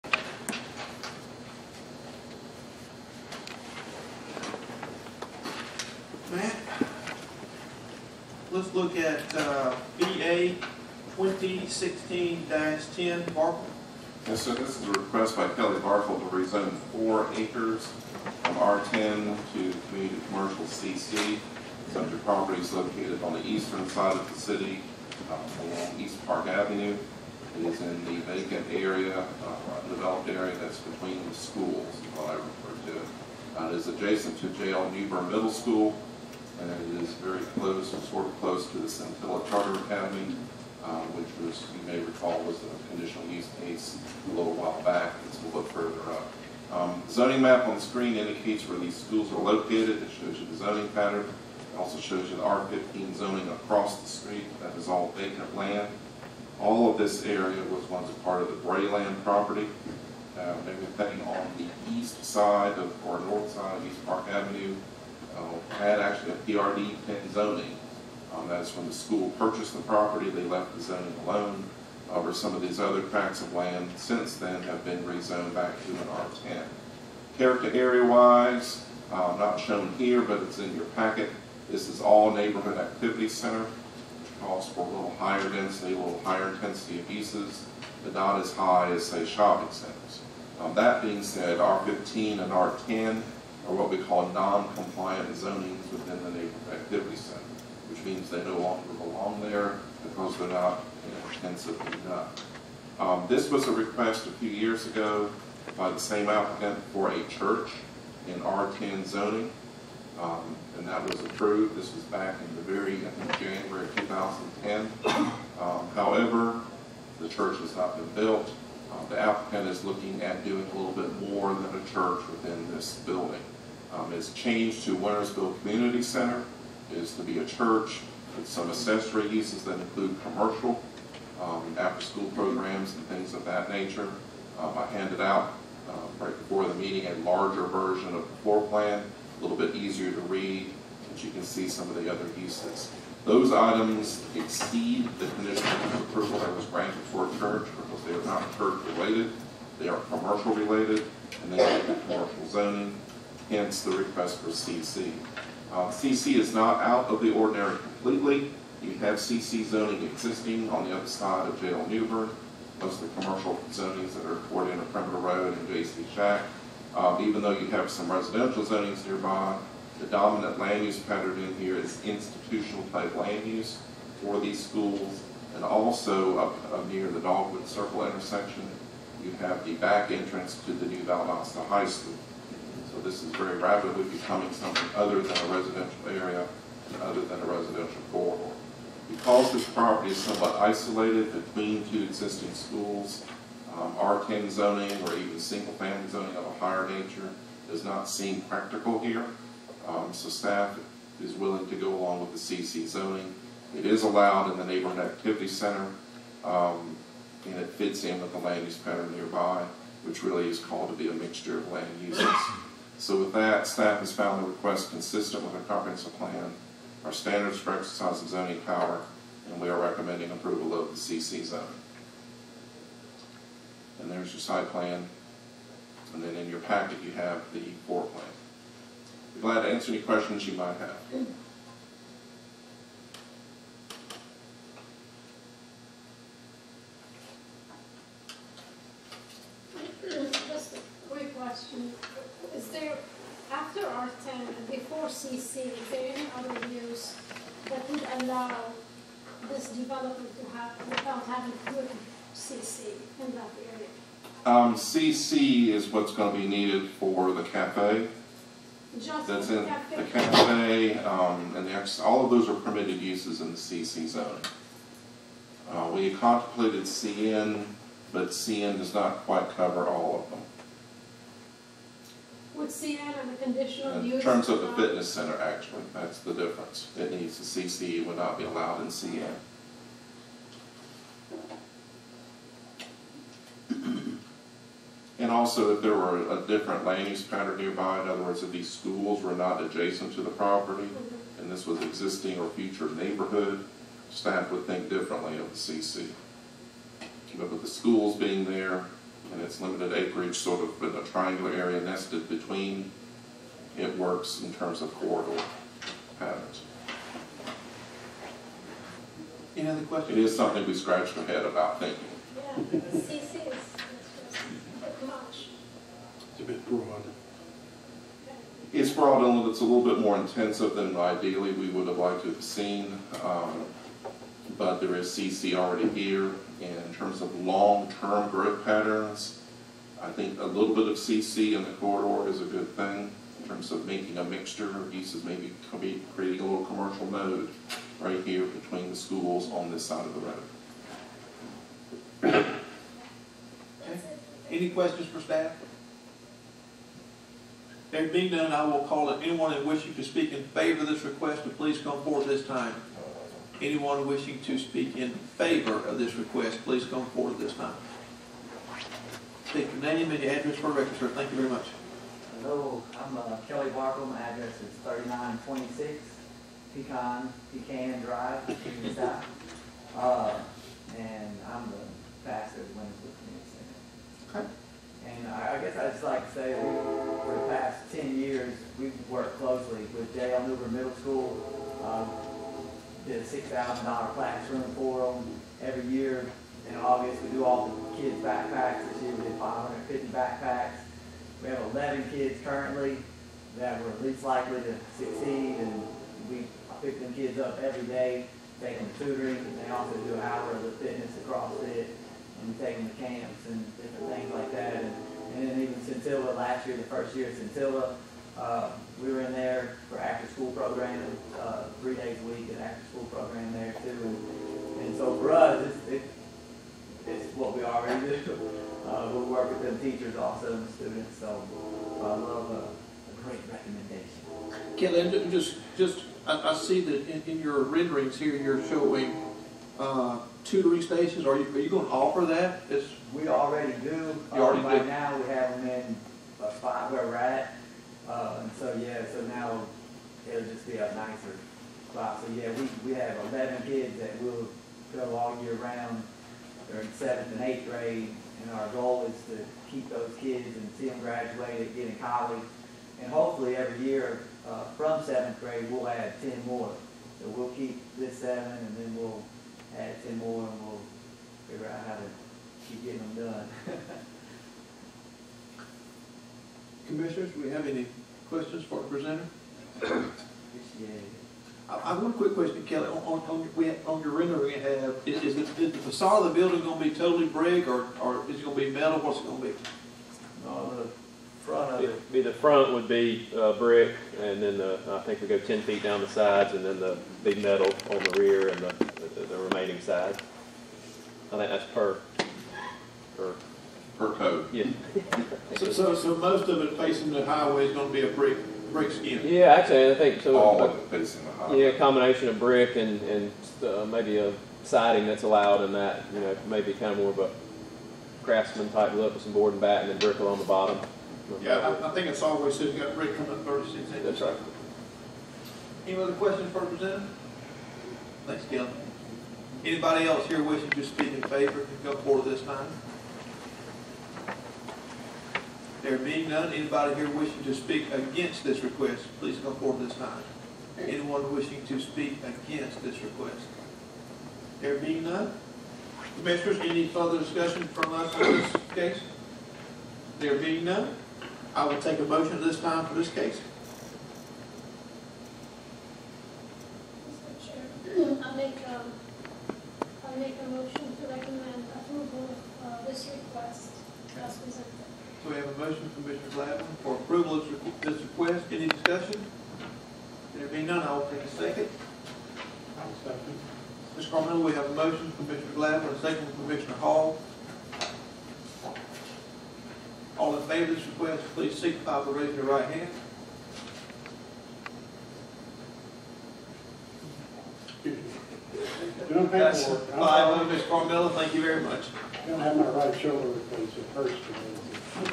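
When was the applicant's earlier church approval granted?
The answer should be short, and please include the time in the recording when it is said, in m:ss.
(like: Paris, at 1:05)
January 2010, at 1:53.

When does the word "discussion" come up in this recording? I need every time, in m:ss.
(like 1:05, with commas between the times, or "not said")
8:57, 9:18.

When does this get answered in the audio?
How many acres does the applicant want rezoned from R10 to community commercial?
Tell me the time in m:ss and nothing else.
0:16.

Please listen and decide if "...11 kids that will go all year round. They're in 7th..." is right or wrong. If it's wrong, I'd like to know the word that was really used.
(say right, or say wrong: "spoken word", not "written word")
right.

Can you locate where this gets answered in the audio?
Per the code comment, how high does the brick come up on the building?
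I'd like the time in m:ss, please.
8:33.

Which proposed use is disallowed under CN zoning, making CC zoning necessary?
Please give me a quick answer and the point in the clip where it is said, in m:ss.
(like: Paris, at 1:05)
Fitness center, at 4:34.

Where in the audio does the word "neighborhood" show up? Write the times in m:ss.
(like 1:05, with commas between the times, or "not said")
1:22, 1:36, 3:24, 4:53.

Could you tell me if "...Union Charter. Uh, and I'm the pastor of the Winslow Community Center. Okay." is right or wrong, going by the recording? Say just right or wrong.
wrong.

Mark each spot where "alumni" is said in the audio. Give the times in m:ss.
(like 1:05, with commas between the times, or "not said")
not said.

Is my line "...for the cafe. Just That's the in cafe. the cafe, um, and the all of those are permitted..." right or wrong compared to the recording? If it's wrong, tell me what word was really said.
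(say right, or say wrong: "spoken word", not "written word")
right.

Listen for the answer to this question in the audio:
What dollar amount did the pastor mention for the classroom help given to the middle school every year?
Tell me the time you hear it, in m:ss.
6:23.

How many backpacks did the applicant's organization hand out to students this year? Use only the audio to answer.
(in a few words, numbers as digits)
550.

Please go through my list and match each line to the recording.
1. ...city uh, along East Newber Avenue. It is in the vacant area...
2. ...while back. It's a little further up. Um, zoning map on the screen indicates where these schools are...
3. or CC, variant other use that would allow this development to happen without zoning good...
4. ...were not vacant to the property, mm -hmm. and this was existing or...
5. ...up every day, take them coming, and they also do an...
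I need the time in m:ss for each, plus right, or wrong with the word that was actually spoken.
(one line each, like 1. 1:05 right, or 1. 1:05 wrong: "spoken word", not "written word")
1. 0:24 wrong: "Park", not "Newber"
2. 0:44 right
3. 4:05 wrong: "having", not "zoning"
4. 4:49 wrong: "adjacent", not "vacant"
5. 6:37 wrong: "tutoring", not "coming".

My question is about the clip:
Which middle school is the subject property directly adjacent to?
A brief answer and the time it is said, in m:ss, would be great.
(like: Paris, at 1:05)
JL Newbern Middle School, at 0:34.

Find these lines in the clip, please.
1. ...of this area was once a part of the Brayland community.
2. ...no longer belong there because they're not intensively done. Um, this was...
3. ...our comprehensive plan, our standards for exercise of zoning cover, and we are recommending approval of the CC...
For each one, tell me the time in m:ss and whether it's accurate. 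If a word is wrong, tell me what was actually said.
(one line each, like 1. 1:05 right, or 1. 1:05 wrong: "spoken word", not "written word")
1. 0:56 wrong: "property", not "community"
2. 1:38 right
3. 3:35 wrong: "power", not "cover".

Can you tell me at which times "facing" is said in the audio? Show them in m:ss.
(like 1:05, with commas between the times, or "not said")
8:16, 8:20.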